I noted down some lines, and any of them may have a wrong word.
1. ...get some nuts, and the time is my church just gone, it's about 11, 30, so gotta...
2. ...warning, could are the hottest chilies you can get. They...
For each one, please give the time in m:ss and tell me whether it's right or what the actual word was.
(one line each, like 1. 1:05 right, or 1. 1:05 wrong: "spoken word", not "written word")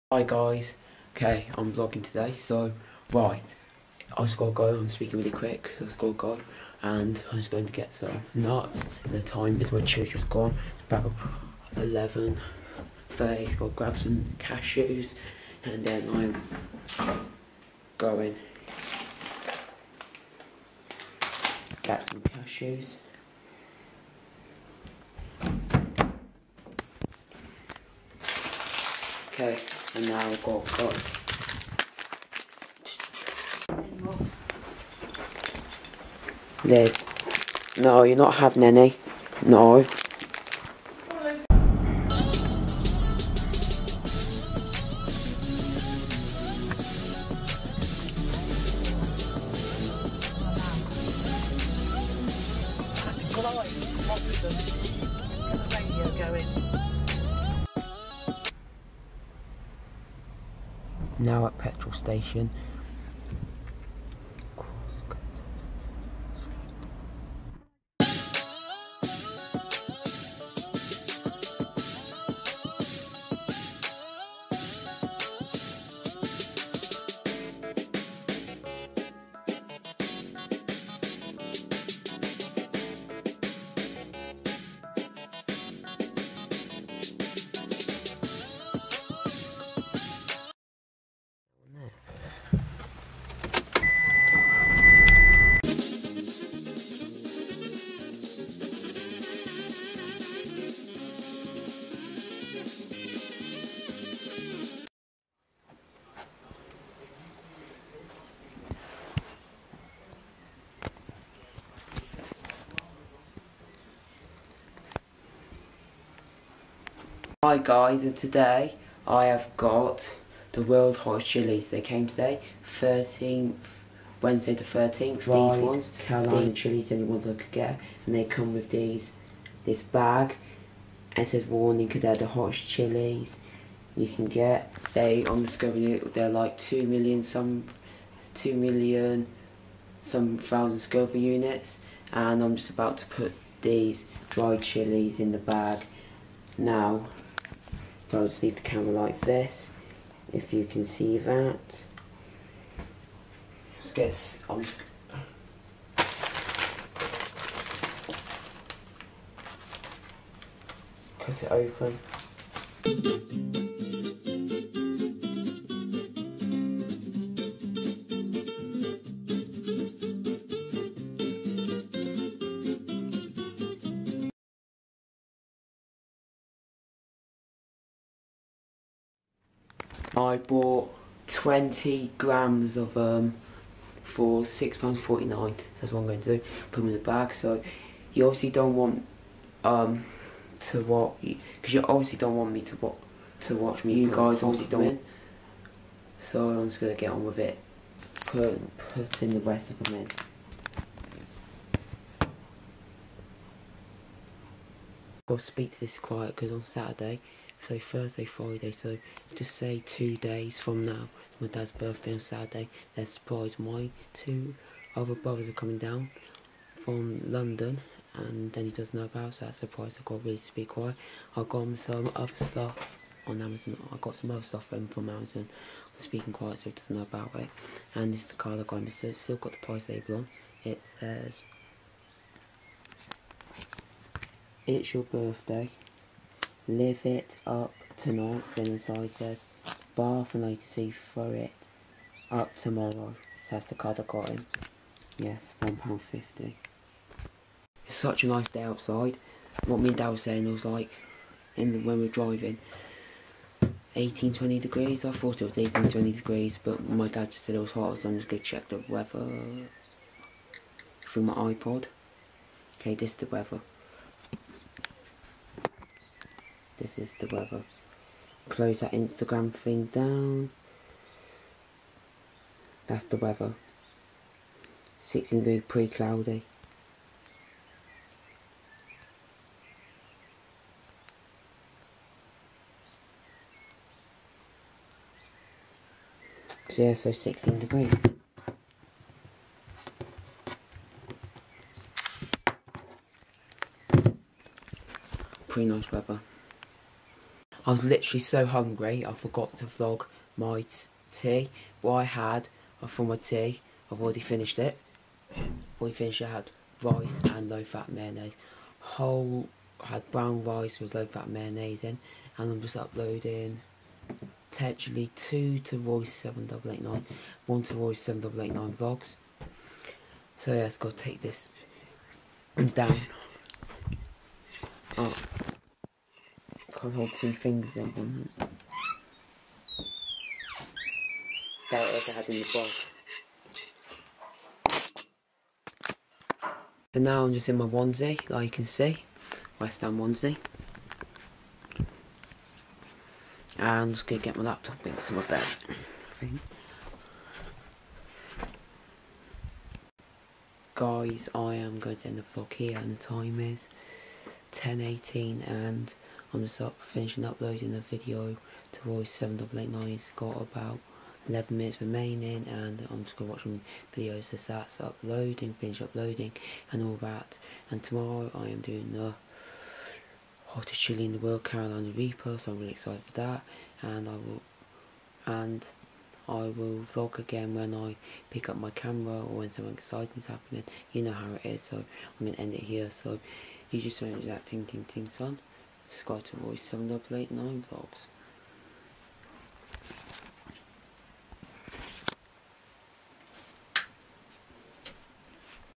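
1. 0:07 right
2. 2:11 right.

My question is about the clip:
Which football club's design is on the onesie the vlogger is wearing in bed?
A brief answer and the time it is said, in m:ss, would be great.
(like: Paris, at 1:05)
West Ham, at 5:39.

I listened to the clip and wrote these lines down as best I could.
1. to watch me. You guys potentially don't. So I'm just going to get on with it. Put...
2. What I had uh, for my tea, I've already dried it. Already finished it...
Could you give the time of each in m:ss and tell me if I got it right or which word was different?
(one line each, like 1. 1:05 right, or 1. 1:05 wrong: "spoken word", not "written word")
1. 3:13 wrong: "obviously", not "potentially"
2. 5:01 wrong: "finished", not "dried".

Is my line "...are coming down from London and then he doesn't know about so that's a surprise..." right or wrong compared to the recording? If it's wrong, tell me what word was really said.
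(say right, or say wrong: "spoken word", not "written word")
right.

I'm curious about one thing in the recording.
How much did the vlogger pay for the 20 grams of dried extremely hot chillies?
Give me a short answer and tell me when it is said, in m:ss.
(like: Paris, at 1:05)
£6.49, at 3:04.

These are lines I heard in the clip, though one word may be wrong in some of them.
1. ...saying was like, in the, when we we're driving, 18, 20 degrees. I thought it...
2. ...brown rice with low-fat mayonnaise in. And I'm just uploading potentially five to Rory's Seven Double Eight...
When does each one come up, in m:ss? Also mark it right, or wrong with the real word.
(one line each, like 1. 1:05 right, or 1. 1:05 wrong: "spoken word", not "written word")
1. 4:10 right
2. 5:10 wrong: "two", not "five".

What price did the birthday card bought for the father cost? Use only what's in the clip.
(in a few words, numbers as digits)
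£1.50.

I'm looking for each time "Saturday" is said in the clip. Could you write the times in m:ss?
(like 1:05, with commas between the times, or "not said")
3:26, 3:32.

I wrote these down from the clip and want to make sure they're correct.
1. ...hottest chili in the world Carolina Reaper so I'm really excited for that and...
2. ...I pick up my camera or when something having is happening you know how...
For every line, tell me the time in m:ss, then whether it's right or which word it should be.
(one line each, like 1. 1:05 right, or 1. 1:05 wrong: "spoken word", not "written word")
1. 6:10 right
2. 6:17 wrong: "exciting", not "having".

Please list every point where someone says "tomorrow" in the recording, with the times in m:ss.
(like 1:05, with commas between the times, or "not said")
4:02, 6:07.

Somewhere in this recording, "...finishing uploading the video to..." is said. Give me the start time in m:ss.
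5:56.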